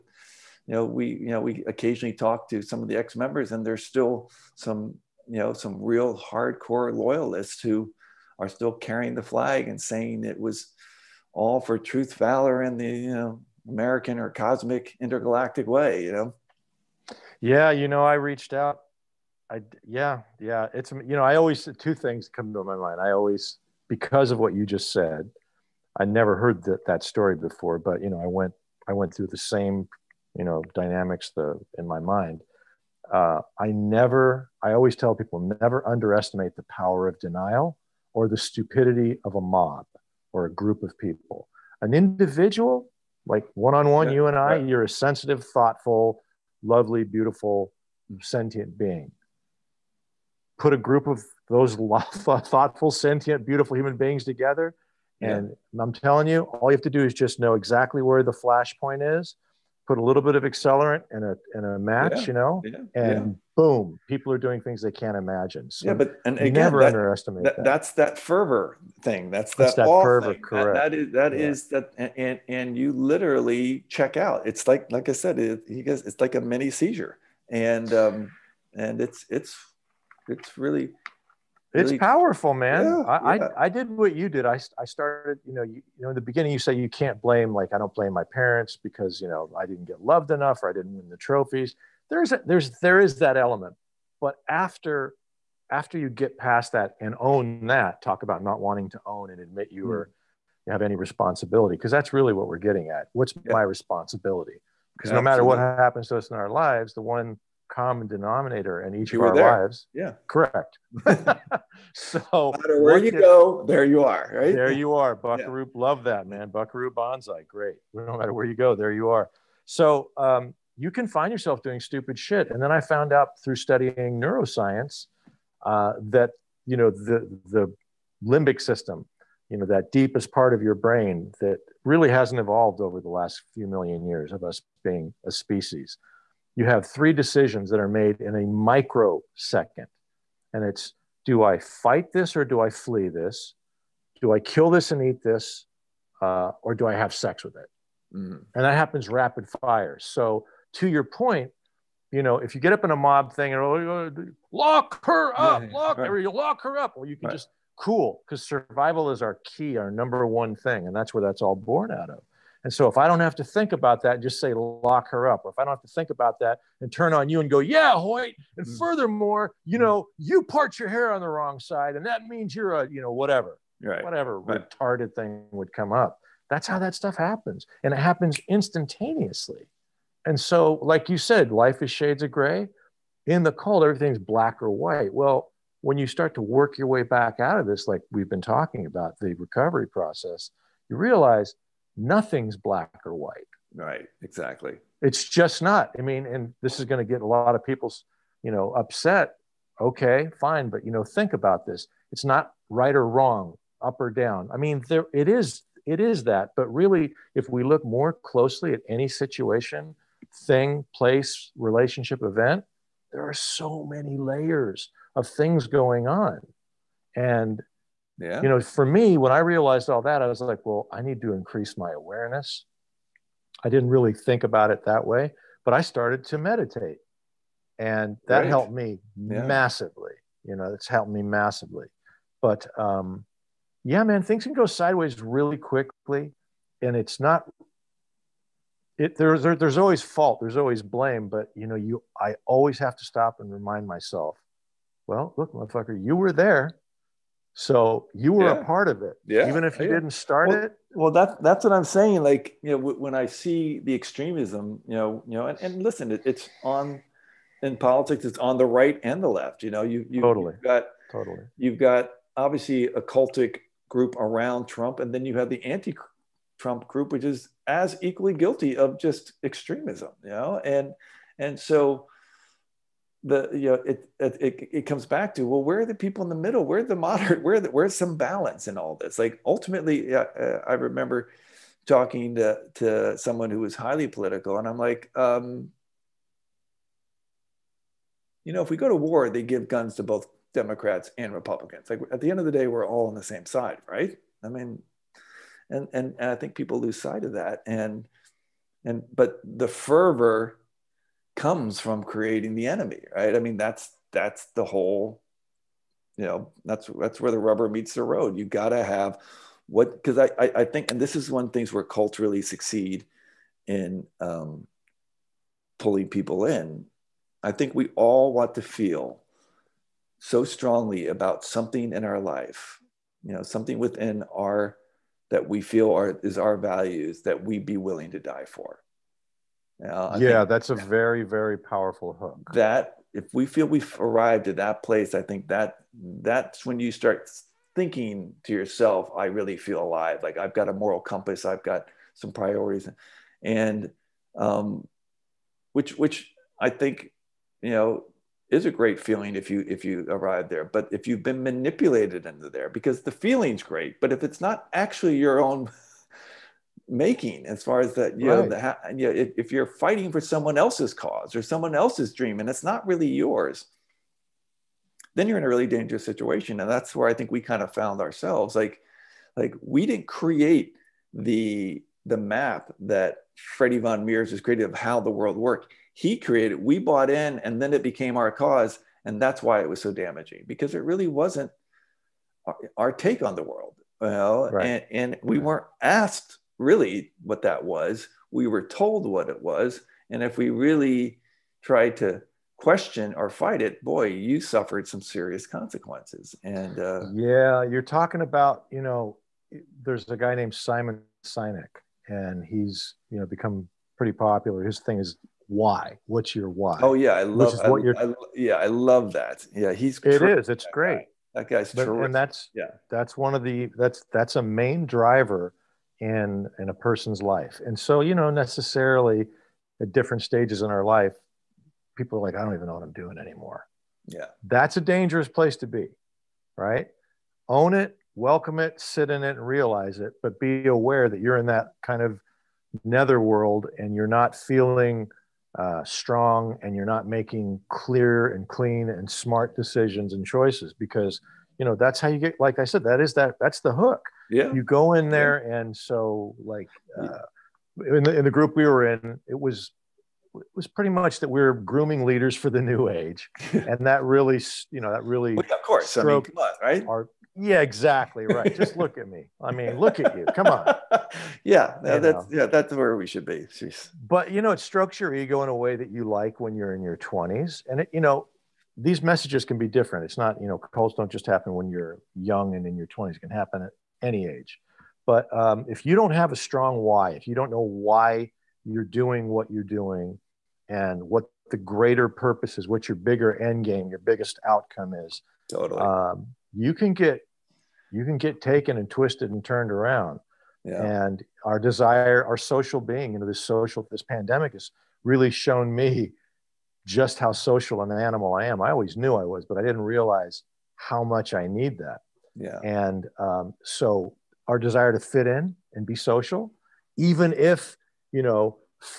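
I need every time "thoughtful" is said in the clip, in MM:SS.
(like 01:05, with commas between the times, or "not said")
00:45, 00:52.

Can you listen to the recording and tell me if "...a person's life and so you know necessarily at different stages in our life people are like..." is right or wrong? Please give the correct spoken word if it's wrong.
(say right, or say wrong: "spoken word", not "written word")
right.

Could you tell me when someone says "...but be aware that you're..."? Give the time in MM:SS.
07:10.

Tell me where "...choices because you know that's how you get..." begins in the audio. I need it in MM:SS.
07:20.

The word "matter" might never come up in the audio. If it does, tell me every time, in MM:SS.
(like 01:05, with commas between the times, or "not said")
01:45, 01:52, 01:58.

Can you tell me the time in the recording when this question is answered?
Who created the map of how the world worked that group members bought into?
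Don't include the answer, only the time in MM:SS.
06:13.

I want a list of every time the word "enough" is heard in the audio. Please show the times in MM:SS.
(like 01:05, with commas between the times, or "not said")
01:30.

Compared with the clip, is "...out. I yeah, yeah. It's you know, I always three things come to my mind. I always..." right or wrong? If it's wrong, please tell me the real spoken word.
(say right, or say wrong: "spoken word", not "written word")
wrong: "two", not "three".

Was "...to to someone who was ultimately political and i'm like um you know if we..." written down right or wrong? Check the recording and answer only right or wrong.
wrong.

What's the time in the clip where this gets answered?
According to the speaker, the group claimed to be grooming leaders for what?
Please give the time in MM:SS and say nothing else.
07:32.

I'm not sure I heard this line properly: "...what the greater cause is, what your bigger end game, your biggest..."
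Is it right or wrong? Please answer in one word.
wrong.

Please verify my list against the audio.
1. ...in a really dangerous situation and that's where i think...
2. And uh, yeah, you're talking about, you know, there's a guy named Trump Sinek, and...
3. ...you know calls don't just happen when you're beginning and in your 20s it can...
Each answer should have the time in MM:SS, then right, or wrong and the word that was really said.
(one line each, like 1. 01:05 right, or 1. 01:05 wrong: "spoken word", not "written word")
1. 06:05 right
2. 06:36 wrong: "Simon", not "Trump"
3. 07:50 wrong: "young", not "beginning".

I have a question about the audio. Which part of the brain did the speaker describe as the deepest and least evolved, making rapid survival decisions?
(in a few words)
limbic system.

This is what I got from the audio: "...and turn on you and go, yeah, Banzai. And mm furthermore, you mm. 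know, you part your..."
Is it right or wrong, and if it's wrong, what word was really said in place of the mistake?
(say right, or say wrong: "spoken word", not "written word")
wrong: "Hoyt", not "Banzai".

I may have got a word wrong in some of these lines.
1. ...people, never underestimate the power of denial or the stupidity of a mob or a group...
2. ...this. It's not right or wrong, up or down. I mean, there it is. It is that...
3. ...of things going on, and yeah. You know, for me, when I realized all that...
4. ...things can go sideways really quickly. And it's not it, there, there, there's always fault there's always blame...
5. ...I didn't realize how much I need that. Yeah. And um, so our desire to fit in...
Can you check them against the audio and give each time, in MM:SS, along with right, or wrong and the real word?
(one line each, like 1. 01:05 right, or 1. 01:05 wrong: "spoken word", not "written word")
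1. 00:35 right
2. 03:21 right
3. 03:35 right
4. 03:54 right
5. 08:19 right.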